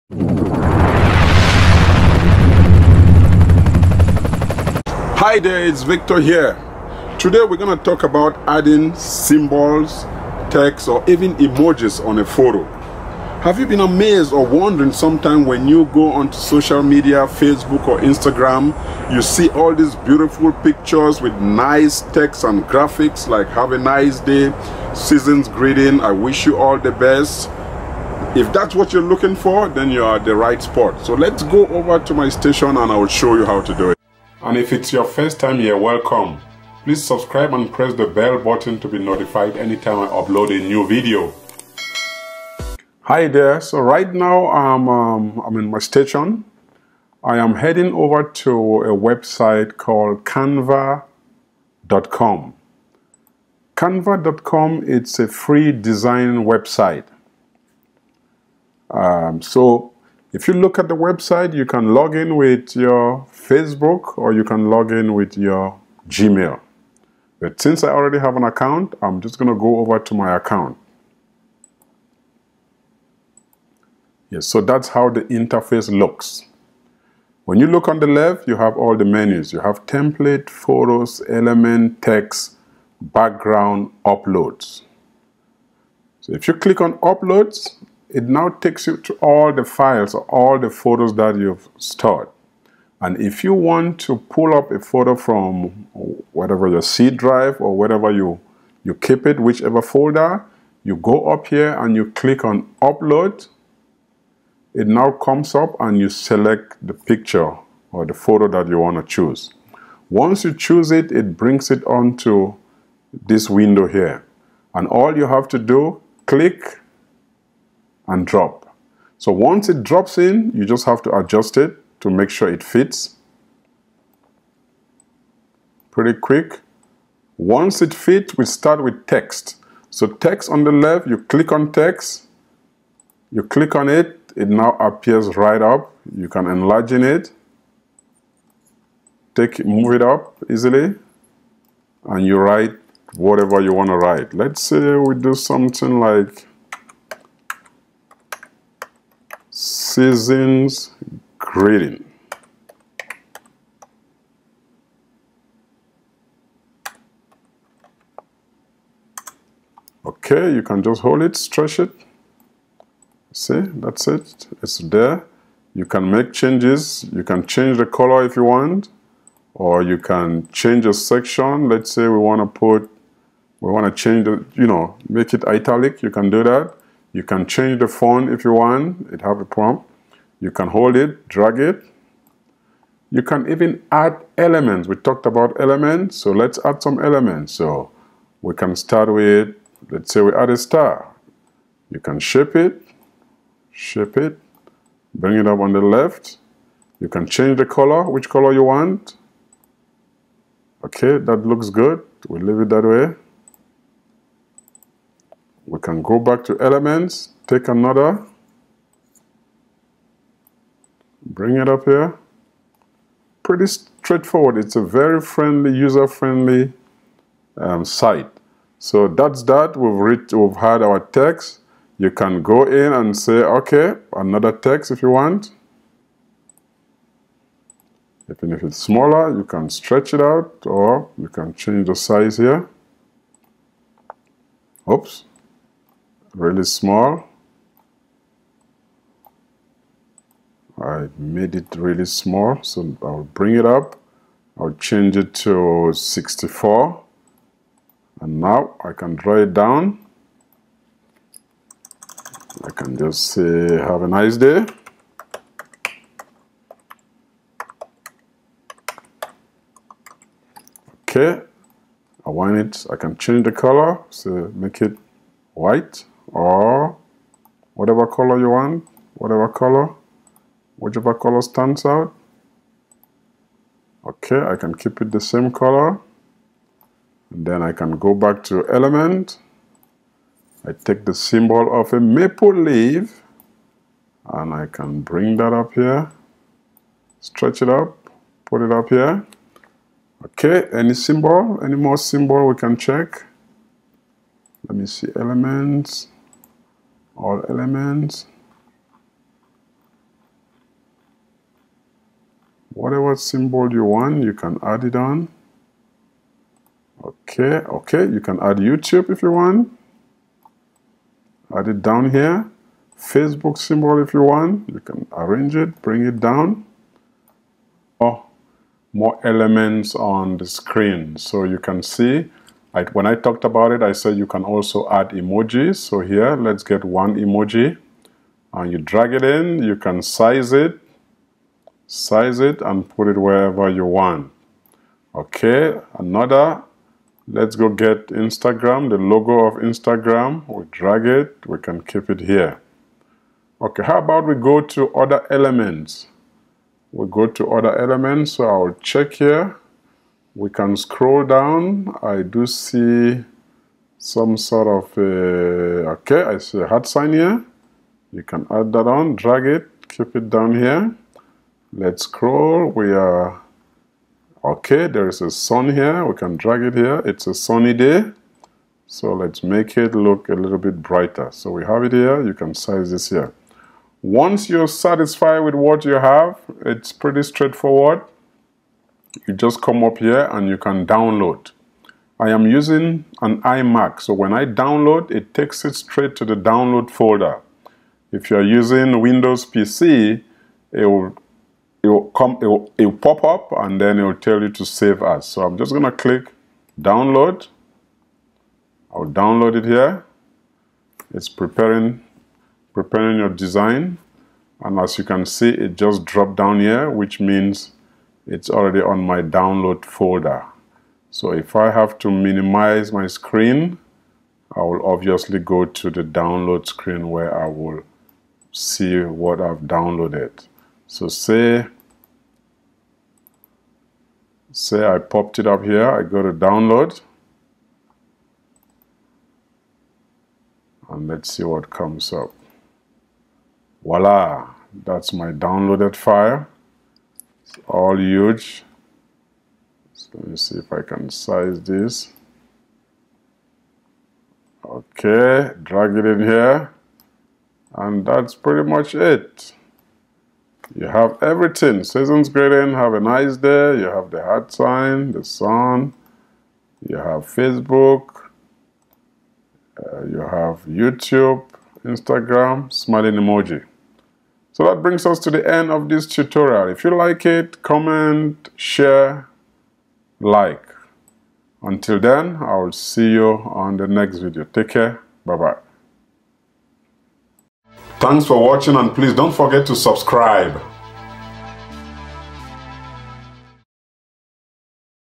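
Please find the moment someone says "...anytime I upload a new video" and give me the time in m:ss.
0:39.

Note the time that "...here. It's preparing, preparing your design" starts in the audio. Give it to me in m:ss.
6:39.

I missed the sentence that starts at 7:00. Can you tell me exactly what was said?
So say, say I popped it up here, I go to download, and let's see what comes up.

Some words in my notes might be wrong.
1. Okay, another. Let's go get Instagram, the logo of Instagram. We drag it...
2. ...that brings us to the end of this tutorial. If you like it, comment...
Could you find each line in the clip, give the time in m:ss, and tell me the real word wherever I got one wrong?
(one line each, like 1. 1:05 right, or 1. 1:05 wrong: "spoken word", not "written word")
1. 5:35 right
2. 7:44 right.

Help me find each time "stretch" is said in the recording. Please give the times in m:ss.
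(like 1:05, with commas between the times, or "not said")
2:41, 3:49, 4:47.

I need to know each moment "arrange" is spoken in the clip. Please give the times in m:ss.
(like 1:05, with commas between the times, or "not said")
5:15.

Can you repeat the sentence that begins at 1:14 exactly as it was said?
Yes, so that's how the interface looks.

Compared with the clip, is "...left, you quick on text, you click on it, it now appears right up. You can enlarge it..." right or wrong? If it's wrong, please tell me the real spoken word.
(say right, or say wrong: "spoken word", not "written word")
wrong: "click", not "quick".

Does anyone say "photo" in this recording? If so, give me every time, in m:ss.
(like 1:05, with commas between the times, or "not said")
0:12, 1:20, 1:30, 1:34, 1:48.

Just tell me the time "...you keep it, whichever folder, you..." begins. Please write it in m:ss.
1:38.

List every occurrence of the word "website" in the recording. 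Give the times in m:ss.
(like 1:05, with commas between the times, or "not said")
0:48, 0:56, 1:00.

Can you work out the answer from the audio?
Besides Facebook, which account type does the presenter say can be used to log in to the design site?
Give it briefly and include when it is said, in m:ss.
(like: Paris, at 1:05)
Gmail, at 1:06.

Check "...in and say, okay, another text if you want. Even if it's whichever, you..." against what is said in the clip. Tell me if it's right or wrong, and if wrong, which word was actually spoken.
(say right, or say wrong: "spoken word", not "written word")
wrong: "smaller", not "whichever".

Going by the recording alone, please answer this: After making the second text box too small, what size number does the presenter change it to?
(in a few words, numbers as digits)
64.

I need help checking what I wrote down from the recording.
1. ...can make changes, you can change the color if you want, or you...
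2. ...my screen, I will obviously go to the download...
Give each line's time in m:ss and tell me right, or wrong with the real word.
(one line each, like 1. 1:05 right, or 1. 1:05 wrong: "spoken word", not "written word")
1. 2:45 right
2. 6:52 right.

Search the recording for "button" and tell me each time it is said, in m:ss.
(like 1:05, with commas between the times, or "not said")
0:38.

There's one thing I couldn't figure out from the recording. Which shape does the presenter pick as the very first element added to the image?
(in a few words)
A star.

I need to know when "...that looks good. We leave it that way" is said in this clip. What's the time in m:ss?
3:21.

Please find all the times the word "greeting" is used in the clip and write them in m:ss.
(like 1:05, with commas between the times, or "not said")
0:25, 2:31, 7:32.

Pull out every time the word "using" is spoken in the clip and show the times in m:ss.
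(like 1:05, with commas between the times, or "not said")
6:22, 6:28.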